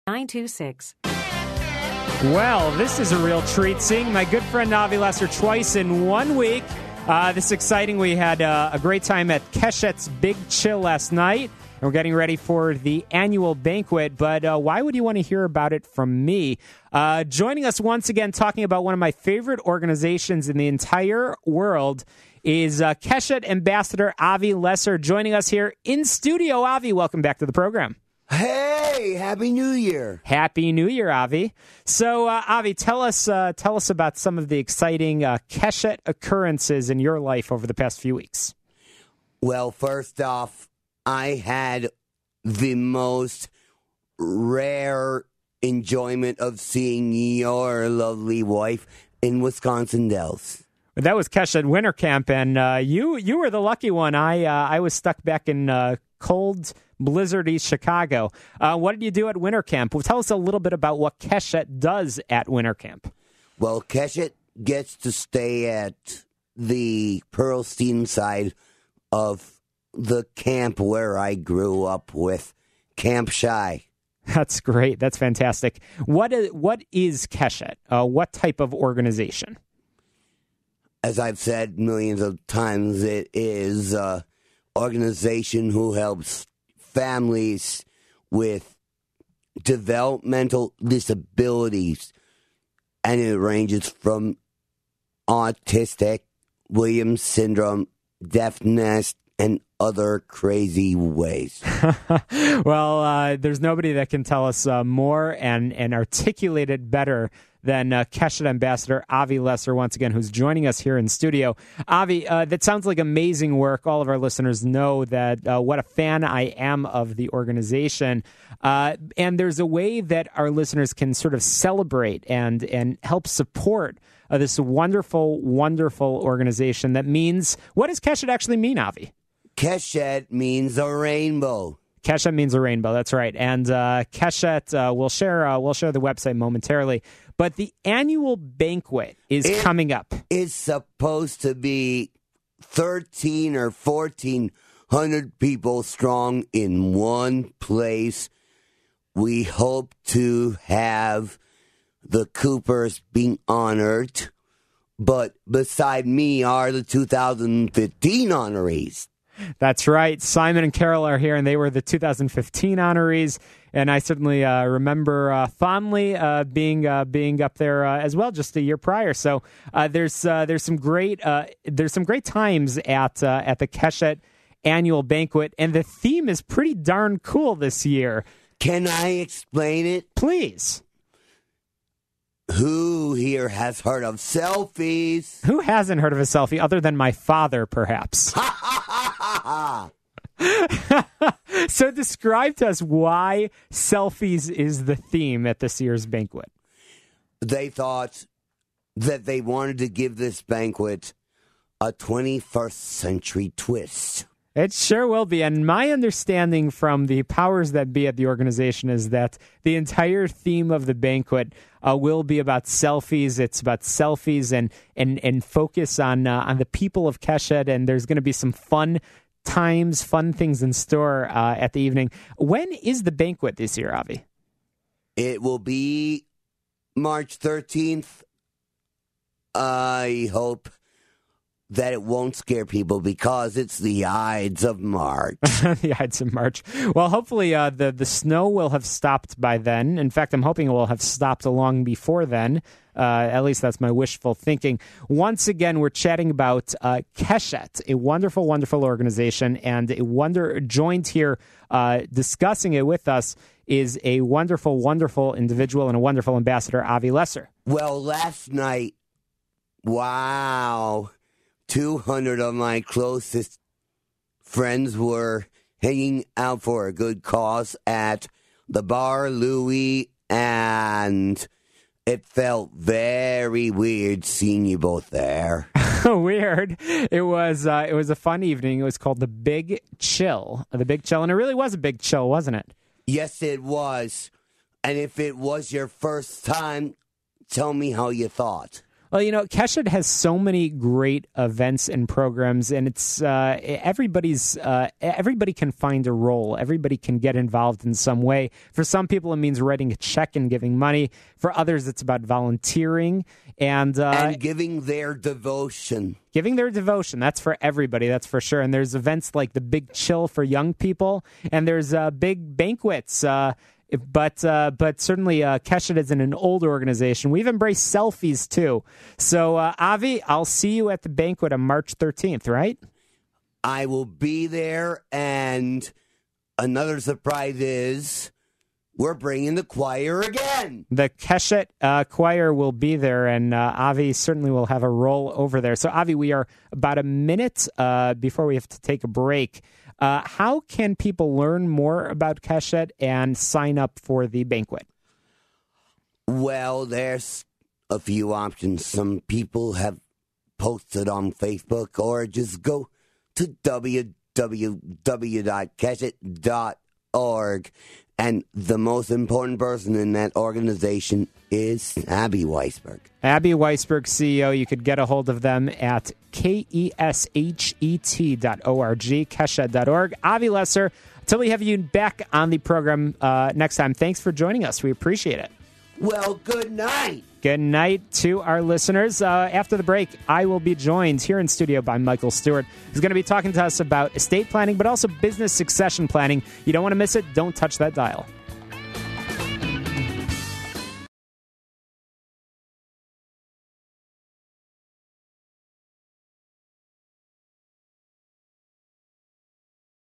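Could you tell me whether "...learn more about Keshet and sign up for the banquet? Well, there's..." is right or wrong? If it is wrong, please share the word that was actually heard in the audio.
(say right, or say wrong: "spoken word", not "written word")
right.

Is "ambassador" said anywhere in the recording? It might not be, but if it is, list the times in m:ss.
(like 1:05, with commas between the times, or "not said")
0:23, 1:48, 4:16.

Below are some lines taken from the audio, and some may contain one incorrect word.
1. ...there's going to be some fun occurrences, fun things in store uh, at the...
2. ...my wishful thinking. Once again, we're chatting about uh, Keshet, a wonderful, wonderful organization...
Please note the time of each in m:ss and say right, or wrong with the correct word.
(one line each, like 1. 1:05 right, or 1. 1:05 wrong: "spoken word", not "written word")
1. 3:37 wrong: "times", not "occurrences"
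2. 4:03 right.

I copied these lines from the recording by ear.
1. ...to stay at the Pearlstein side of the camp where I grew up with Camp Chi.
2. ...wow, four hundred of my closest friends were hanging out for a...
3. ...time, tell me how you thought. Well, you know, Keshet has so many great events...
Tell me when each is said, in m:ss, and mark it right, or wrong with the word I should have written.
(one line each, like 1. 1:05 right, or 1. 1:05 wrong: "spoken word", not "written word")
1. 1:04 right
2. 4:19 wrong: "two", not "four"
3. 4:46 right.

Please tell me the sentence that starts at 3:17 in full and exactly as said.
They thought that they wanted to give this banquet a 21st century twist.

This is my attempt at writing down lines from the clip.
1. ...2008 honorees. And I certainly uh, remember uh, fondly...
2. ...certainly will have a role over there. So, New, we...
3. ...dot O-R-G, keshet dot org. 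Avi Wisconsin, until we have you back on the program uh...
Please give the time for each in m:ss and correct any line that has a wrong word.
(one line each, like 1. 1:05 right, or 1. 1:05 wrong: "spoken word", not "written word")
1. 2:41 wrong: "2015", not "2008"
2. 5:34 wrong: "Avi", not "New"
3. 6:08 wrong: "Lesser", not "Wisconsin".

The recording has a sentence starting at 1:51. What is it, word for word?
Avi, uh, that sounds like amazing work.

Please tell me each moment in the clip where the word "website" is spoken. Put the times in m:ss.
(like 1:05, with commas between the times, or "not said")
2:16.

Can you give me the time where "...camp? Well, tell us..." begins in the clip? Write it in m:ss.
0:59.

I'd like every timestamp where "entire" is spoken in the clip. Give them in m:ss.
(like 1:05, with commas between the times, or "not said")
0:20, 3:29.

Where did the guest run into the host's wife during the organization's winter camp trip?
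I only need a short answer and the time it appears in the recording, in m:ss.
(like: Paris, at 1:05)
Wisconsin Dells, at 0:49.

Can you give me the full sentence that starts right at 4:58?
For some people, it means writing a check and giving money.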